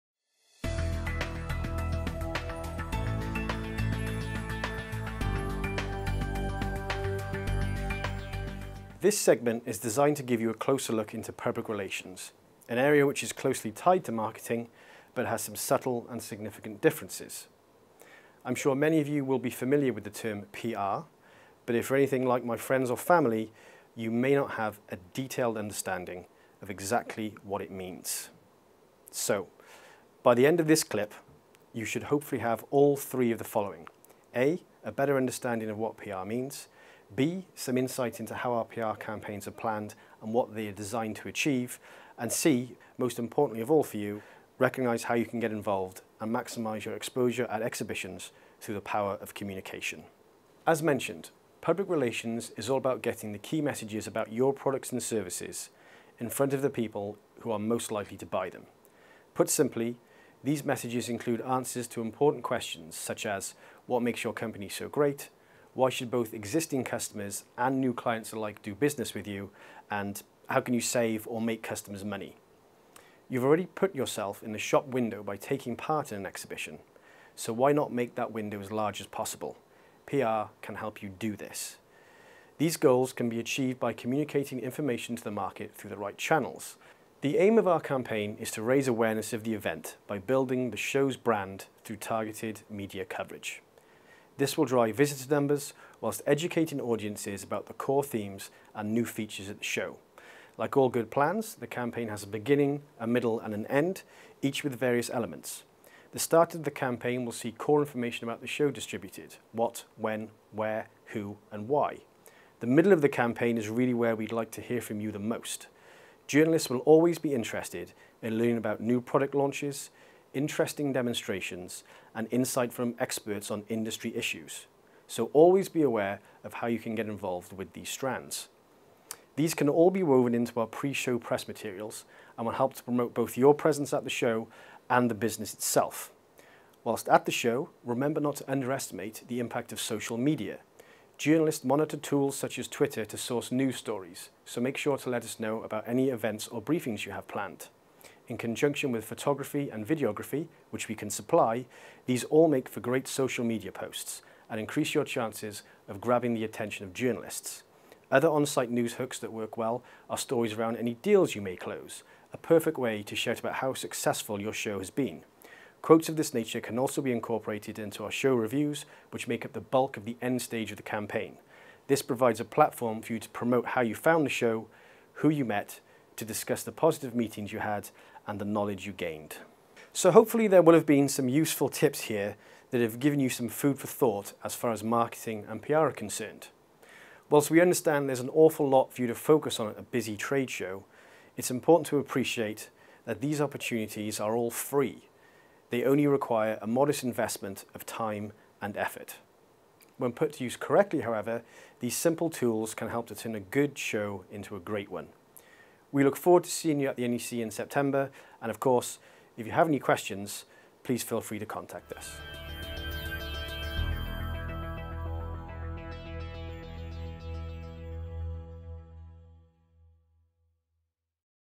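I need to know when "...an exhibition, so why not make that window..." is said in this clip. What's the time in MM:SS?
01:16.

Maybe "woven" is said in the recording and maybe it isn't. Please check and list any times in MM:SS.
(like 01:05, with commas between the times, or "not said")
02:10.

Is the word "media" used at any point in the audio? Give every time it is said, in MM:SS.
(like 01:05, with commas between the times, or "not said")
01:32, 02:20, 02:33.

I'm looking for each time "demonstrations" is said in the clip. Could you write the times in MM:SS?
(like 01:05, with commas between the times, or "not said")
02:00.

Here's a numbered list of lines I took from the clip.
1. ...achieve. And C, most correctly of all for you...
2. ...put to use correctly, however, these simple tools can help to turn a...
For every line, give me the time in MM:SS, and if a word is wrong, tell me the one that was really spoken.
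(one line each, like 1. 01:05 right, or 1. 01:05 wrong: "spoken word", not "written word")
1. 00:41 wrong: "importantly", not "correctly"
2. 03:20 right.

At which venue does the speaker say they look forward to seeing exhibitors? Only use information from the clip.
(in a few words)
NEC.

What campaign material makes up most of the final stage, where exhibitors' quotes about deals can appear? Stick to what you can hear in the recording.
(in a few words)
Show reviews.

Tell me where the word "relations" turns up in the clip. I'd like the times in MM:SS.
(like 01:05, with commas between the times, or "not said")
00:11, 00:51.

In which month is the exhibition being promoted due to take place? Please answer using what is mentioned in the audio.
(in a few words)
September.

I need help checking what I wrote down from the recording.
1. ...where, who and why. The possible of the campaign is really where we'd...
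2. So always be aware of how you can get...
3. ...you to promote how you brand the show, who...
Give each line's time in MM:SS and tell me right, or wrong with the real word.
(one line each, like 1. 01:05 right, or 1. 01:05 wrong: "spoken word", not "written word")
1. 01:50 wrong: "middle", not "possible"
2. 02:05 right
3. 02:53 wrong: "found", not "brand".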